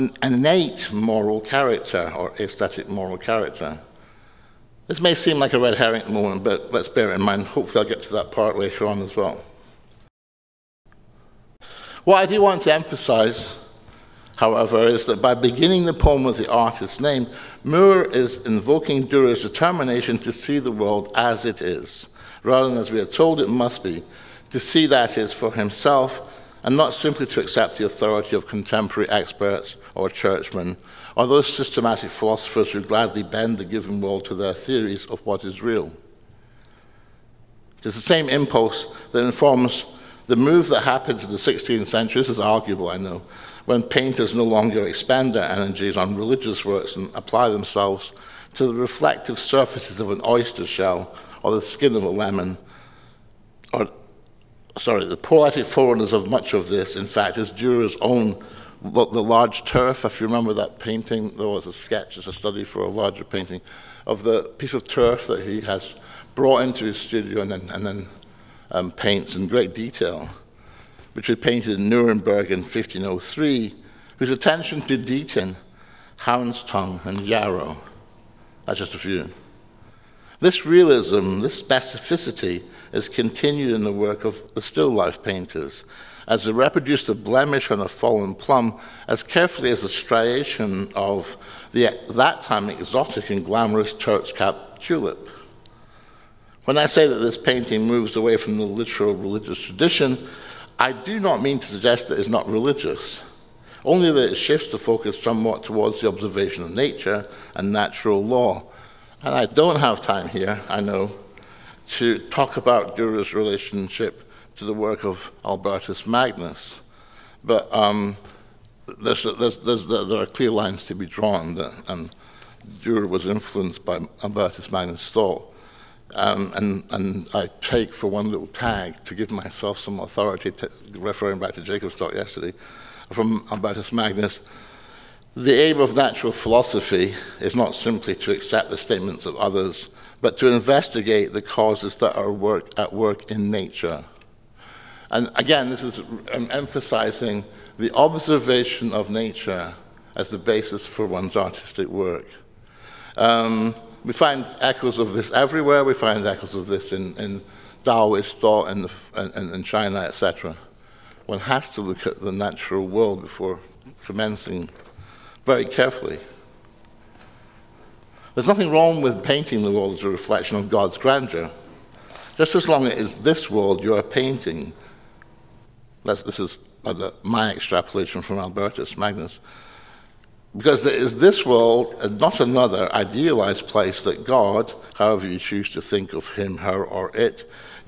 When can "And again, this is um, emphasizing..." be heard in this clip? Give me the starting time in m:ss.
2:25.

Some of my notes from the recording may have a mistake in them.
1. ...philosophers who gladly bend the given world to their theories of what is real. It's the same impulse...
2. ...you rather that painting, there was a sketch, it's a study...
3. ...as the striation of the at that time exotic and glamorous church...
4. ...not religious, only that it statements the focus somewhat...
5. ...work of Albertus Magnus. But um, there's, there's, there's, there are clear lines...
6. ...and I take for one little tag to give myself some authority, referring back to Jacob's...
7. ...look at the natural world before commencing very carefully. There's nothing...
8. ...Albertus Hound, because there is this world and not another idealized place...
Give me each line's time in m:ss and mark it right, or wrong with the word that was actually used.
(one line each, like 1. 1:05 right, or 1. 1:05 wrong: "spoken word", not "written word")
1. 0:32 right
2. 1:00 wrong: "remember", not "rather"
3. 1:29 right
4. 1:42 wrong: "shifts", not "statements"
5. 1:54 right
6. 2:06 right
7. 2:41 right
8. 2:58 wrong: "Magnus", not "Hound".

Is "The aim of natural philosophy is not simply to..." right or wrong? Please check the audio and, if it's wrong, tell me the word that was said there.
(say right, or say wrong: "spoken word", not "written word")
right.